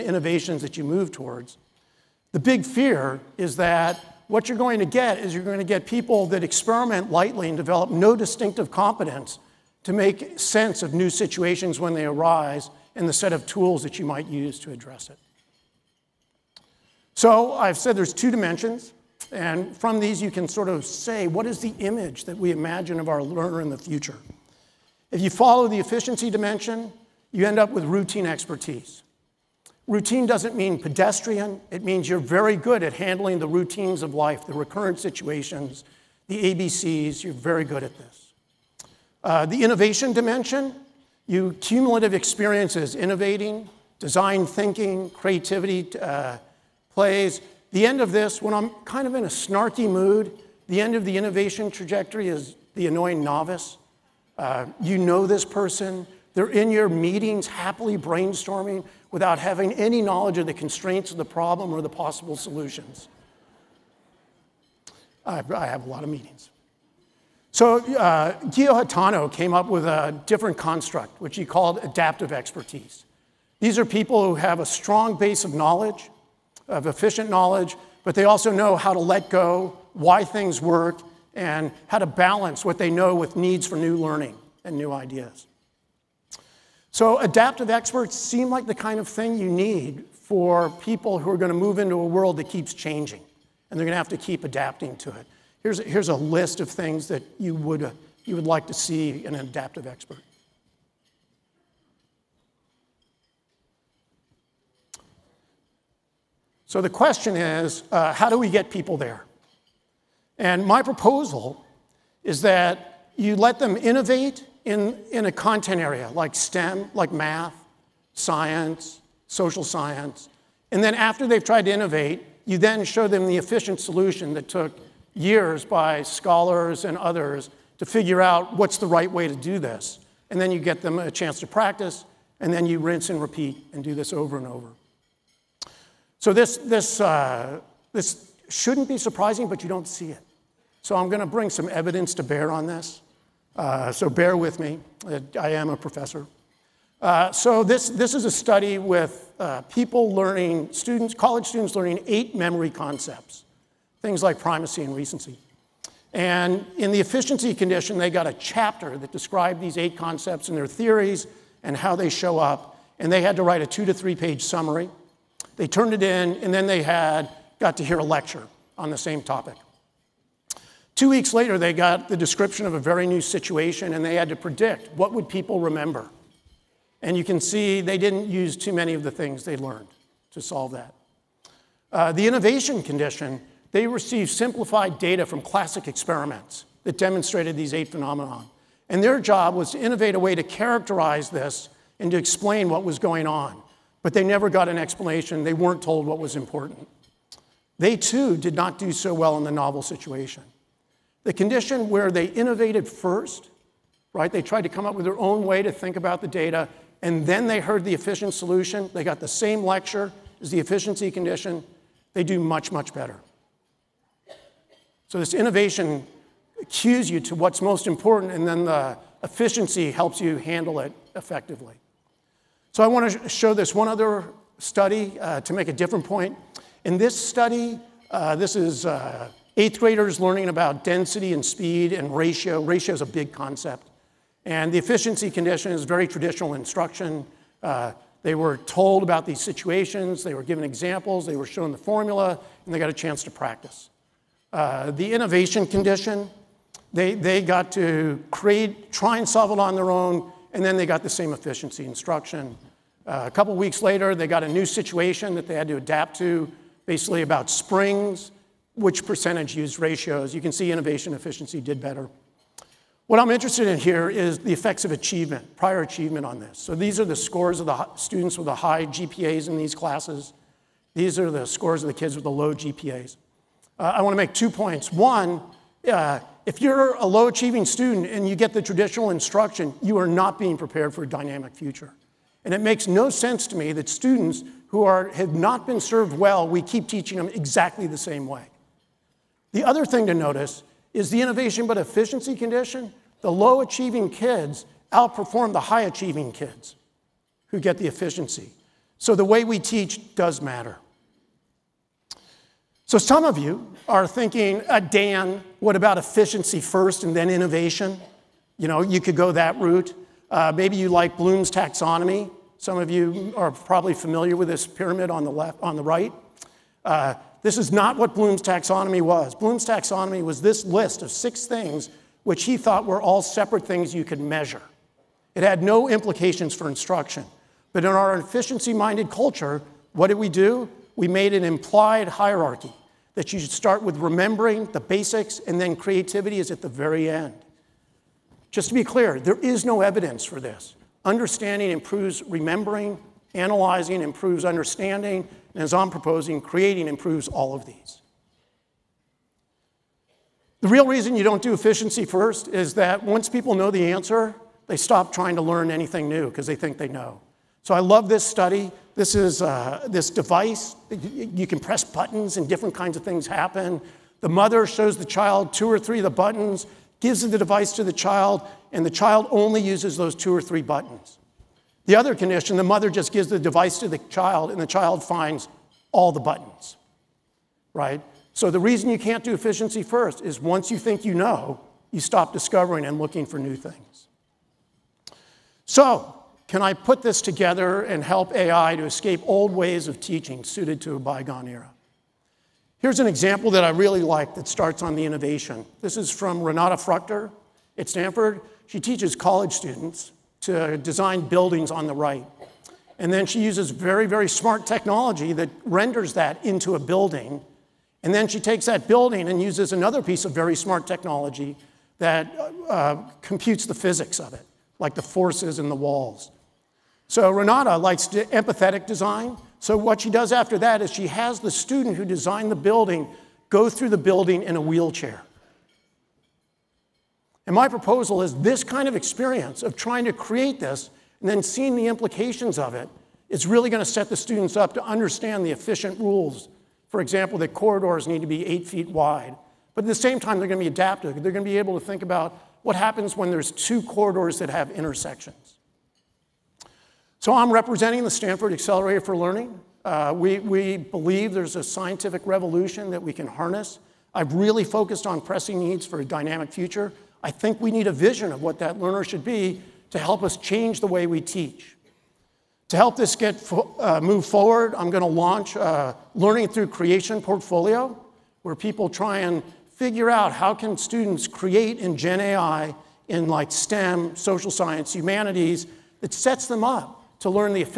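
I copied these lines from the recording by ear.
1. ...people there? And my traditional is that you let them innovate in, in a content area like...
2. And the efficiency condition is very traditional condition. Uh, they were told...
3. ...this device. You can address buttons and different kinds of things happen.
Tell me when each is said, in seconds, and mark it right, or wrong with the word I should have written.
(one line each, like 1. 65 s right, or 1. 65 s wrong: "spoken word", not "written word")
1. 108 s wrong: "proposal", not "traditional"
2. 234 s wrong: "instruction", not "condition"
3. 359 s wrong: "press", not "address".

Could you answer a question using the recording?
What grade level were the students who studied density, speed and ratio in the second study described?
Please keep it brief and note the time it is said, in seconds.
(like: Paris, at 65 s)
eighth graders, at 229 s.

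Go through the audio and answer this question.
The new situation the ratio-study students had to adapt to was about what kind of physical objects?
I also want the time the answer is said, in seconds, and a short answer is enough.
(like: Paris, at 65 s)
springs, at 257 s.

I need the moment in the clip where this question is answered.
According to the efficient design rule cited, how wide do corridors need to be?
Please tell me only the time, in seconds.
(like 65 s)
438 s.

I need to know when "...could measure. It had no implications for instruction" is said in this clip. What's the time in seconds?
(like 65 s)
324 s.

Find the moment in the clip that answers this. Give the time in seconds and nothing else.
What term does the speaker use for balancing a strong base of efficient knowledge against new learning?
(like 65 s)
71 s.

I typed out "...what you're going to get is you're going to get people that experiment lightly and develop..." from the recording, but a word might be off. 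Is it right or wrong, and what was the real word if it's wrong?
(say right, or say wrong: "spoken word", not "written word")
right.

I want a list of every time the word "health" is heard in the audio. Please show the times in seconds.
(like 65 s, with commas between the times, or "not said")
not said.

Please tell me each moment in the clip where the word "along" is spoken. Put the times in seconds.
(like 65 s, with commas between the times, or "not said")
not said.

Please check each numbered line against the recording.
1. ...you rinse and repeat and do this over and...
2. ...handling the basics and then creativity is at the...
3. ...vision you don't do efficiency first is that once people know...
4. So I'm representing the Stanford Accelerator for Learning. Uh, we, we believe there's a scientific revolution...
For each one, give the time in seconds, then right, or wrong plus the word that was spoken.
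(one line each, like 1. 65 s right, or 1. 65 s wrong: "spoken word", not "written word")
1. 132 s right
2. 333 s wrong: "remembering", not "handling"
3. 350 s wrong: "reason", not "vision"
4. 447 s right.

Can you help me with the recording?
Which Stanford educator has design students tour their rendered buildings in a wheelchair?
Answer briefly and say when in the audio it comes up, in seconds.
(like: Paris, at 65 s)
Renate Fruchter, at 396 s.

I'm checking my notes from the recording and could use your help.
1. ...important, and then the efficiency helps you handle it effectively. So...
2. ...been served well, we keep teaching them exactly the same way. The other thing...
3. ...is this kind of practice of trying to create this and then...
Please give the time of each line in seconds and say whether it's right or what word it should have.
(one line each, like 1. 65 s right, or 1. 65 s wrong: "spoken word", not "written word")
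1. 217 s right
2. 285 s right
3. 428 s wrong: "experience", not "practice".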